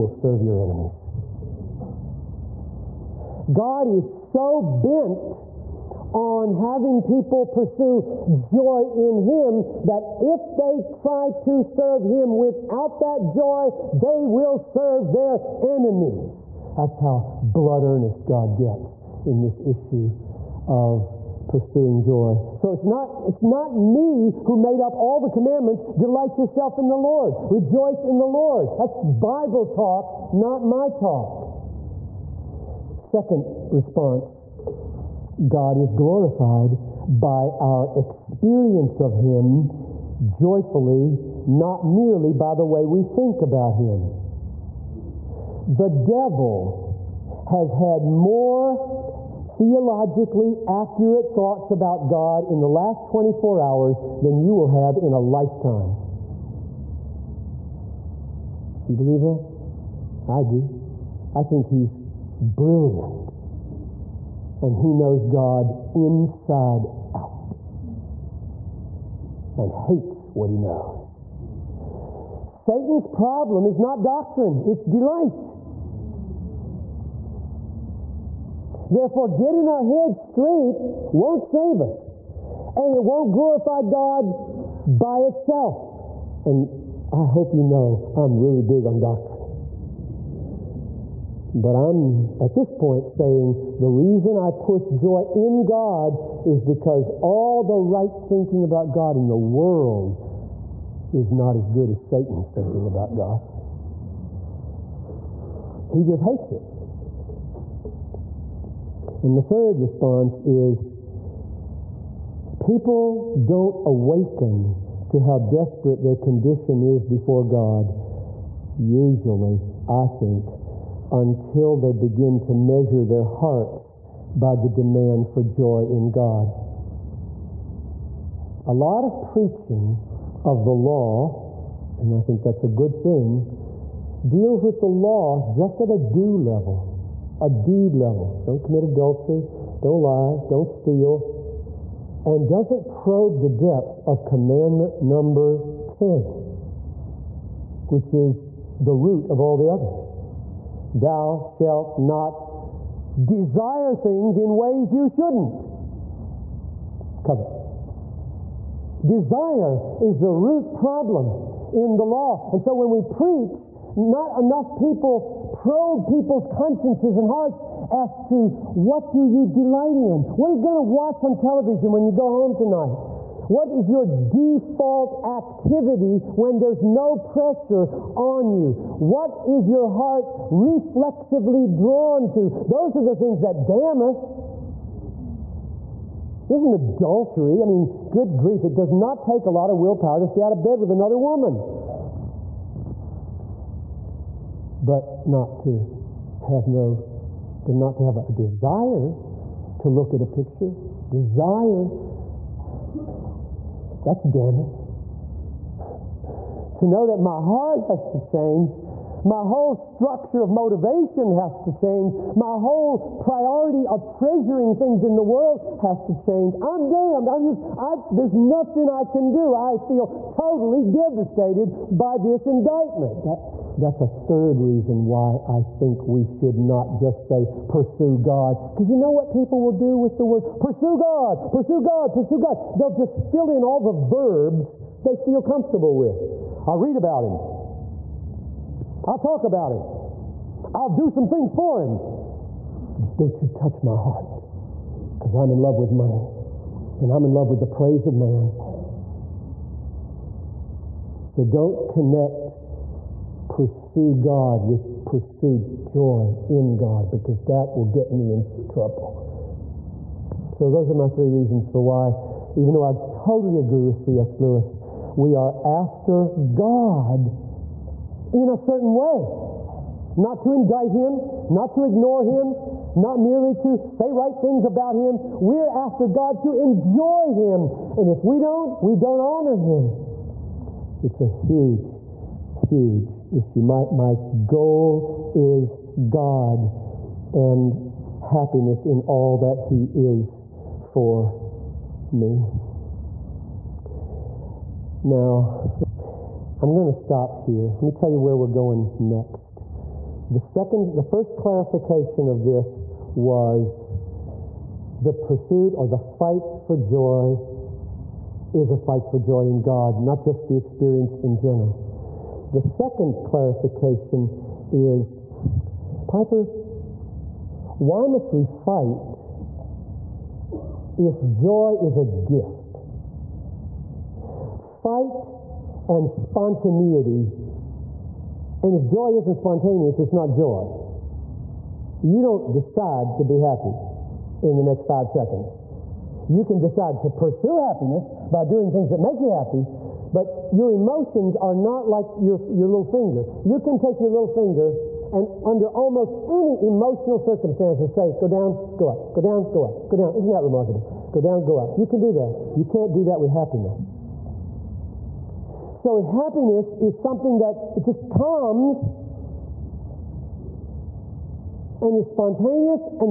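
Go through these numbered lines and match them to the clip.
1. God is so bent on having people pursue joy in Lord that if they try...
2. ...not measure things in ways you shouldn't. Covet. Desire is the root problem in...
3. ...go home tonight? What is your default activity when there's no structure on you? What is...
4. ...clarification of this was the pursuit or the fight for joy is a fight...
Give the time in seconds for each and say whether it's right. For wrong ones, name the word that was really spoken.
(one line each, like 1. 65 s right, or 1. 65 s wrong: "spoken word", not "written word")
1. 3 s wrong: "Him", not "Lord"
2. 151 s wrong: "desire", not "measure"
3. 172 s wrong: "pressure", not "structure"
4. 301 s right.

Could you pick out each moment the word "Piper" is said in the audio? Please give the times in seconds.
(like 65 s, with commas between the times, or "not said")
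316 s.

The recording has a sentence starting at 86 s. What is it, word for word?
And I hope you know I'm really big on doctrine.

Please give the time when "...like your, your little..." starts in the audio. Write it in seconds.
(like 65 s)
341 s.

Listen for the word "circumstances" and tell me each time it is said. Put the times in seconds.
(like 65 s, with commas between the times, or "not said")
347 s.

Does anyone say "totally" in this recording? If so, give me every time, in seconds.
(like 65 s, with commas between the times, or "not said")
220 s, 263 s.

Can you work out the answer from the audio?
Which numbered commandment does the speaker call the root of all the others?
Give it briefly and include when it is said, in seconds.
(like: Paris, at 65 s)
10, at 144 s.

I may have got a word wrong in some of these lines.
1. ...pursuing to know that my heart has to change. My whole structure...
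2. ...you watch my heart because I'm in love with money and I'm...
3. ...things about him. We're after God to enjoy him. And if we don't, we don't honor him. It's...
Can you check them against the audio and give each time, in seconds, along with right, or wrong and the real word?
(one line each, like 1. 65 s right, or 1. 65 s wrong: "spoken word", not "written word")
1. 204 s wrong: "damning", not "pursuing"
2. 243 s wrong: "touch", not "watch"
3. 274 s right.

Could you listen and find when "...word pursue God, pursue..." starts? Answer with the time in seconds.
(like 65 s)
230 s.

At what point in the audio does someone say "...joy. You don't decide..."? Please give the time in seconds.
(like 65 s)
330 s.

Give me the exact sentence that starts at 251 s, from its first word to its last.
So don't connect pursue God with pursue joy in God because that will get me in trouble.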